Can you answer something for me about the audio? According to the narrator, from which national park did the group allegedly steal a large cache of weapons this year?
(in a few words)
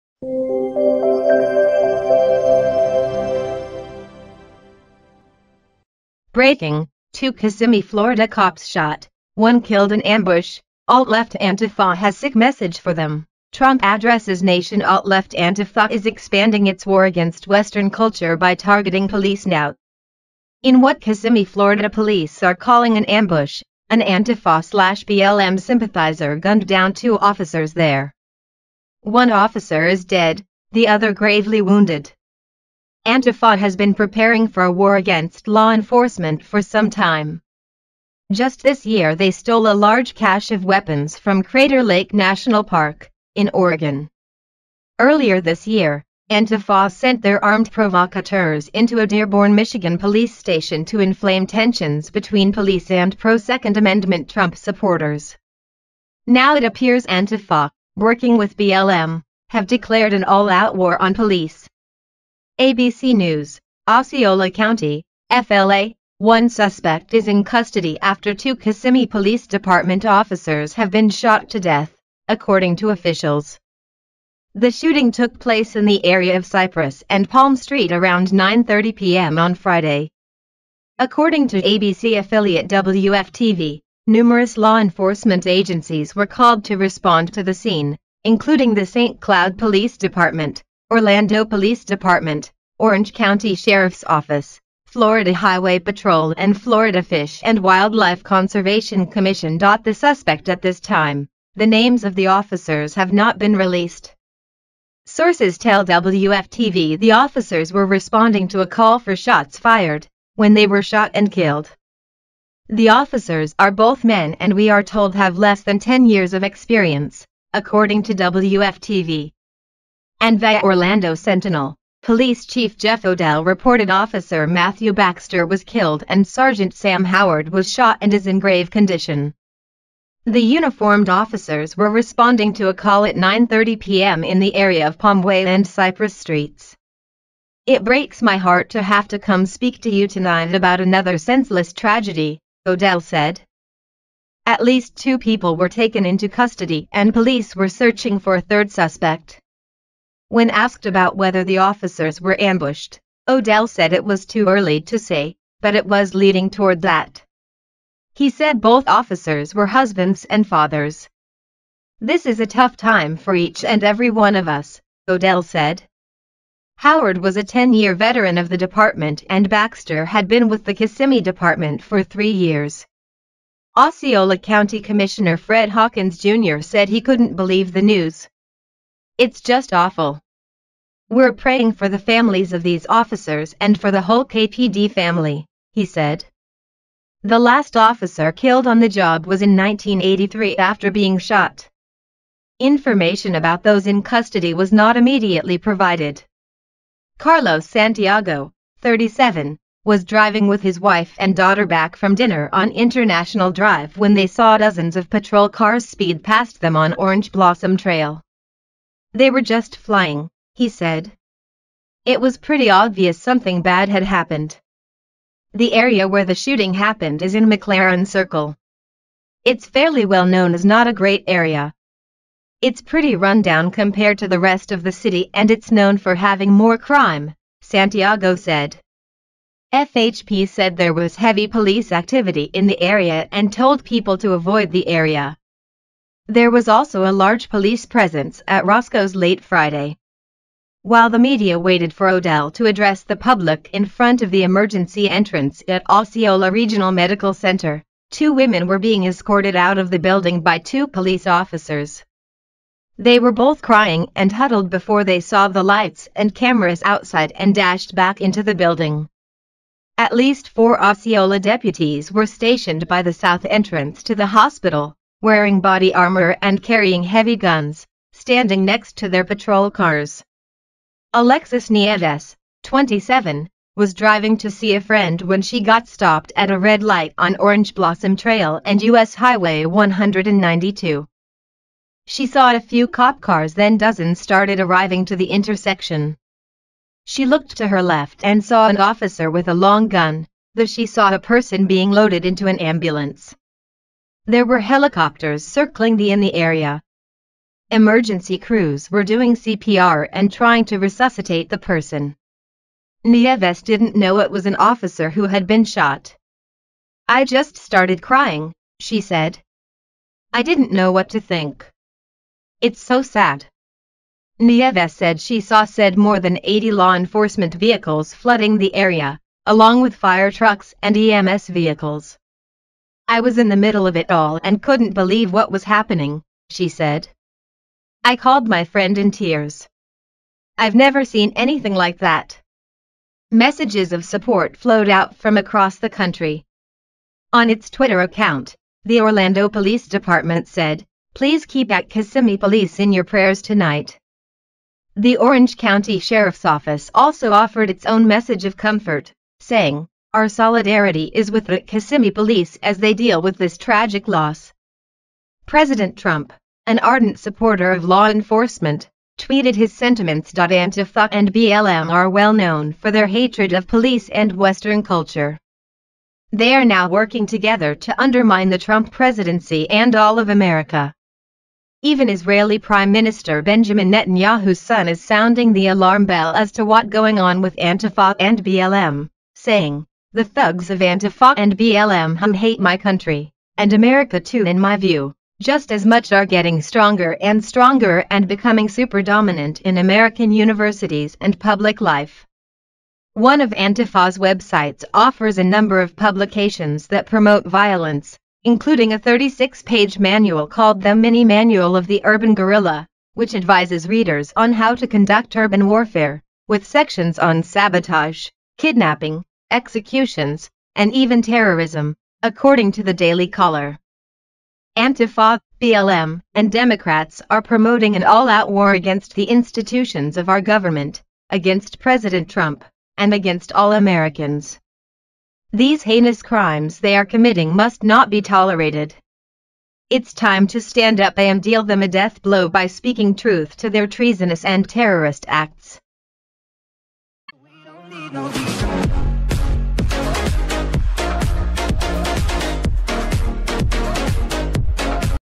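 Crater Lake National Park.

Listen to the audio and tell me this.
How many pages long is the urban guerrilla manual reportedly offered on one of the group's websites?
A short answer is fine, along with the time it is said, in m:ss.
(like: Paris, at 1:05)
36, at 6:38.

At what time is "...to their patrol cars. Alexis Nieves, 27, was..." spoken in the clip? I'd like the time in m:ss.
4:28.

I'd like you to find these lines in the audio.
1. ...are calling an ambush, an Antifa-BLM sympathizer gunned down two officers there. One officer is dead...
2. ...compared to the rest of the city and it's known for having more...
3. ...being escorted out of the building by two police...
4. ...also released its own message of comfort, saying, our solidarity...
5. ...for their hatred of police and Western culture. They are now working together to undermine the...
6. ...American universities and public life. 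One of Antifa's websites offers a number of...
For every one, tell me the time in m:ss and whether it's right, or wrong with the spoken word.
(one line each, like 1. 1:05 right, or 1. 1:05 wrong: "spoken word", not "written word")
1. 0:22 right
2. 3:43 right
3. 4:08 right
4. 5:46 wrong: "offered", not "released"
5. 6:02 right
6. 6:29 right.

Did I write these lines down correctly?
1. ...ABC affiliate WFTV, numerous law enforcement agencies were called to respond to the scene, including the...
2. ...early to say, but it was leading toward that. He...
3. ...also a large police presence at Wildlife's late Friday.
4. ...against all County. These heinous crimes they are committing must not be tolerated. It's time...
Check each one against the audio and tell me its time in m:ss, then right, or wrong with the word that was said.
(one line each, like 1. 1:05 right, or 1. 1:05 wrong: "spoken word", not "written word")
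1. 1:21 right
2. 2:34 right
3. 3:56 wrong: "Roscoe", not "Wildlife"
4. 7:03 wrong: "Americans", not "County".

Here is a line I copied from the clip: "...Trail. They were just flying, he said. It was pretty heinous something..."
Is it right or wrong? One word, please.
wrong.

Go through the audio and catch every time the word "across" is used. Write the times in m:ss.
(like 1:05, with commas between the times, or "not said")
5:35.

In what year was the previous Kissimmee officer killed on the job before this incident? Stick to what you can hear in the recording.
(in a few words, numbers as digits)
1983.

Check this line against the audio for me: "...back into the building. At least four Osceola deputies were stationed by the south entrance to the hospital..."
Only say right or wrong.
right.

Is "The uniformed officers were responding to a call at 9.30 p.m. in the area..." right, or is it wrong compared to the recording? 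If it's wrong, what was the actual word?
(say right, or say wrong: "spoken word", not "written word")
right.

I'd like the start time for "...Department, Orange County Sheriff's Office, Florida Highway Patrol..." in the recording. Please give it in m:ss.
1:31.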